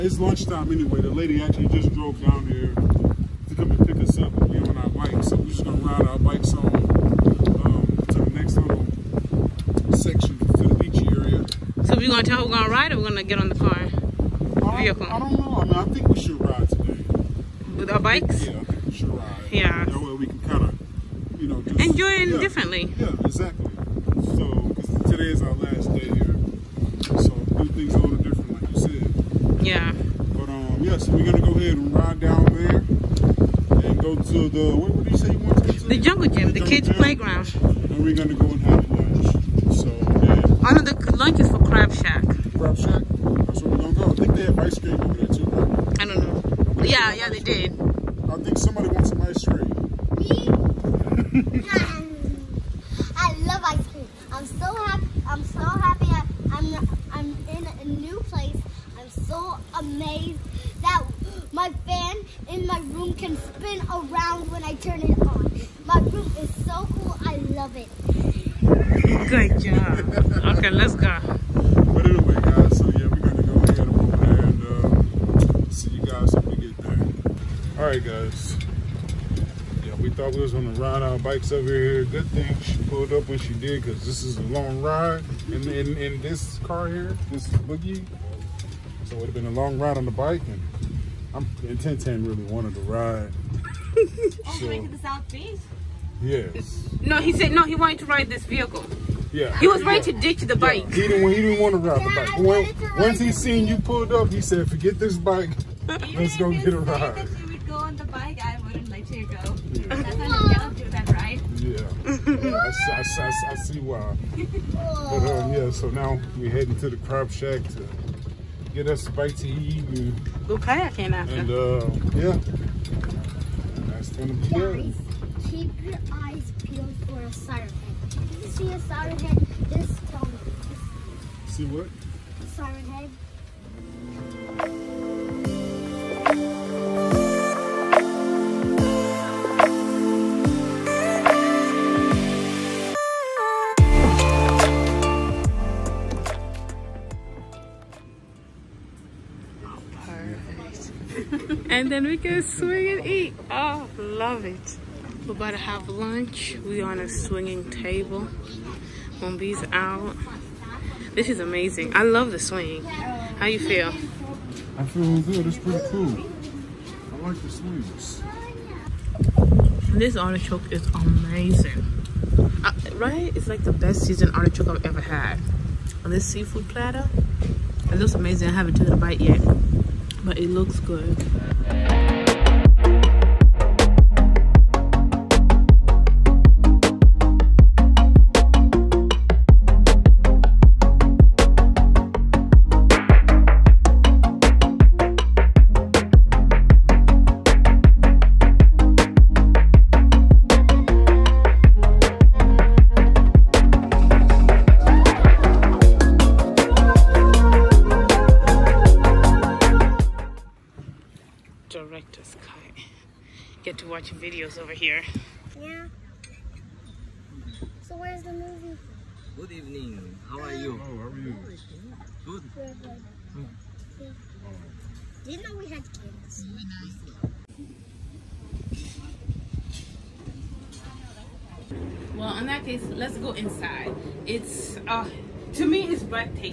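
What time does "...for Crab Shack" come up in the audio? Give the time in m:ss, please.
0:41.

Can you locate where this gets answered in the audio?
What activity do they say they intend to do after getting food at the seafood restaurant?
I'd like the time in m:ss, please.
2:00.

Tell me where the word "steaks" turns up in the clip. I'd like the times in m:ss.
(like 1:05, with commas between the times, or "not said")
not said.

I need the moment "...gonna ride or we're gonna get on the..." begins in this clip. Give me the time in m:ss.
0:12.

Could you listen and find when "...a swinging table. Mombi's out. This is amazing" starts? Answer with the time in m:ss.
2:36.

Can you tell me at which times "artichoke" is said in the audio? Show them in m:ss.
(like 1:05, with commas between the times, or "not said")
2:50, 2:54.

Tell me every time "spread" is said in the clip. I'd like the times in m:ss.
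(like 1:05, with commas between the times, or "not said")
not said.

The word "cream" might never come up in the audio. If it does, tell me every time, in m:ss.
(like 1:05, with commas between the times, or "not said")
0:44, 0:49, 0:53.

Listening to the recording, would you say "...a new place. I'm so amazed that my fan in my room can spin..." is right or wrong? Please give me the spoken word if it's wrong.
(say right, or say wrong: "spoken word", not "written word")
right.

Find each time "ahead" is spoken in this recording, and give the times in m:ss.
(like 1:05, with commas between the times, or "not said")
0:31, 1:13.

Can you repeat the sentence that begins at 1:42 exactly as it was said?
When, once he seen you pulled up, he said, "Forget this bike.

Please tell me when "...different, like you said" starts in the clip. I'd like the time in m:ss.
0:28.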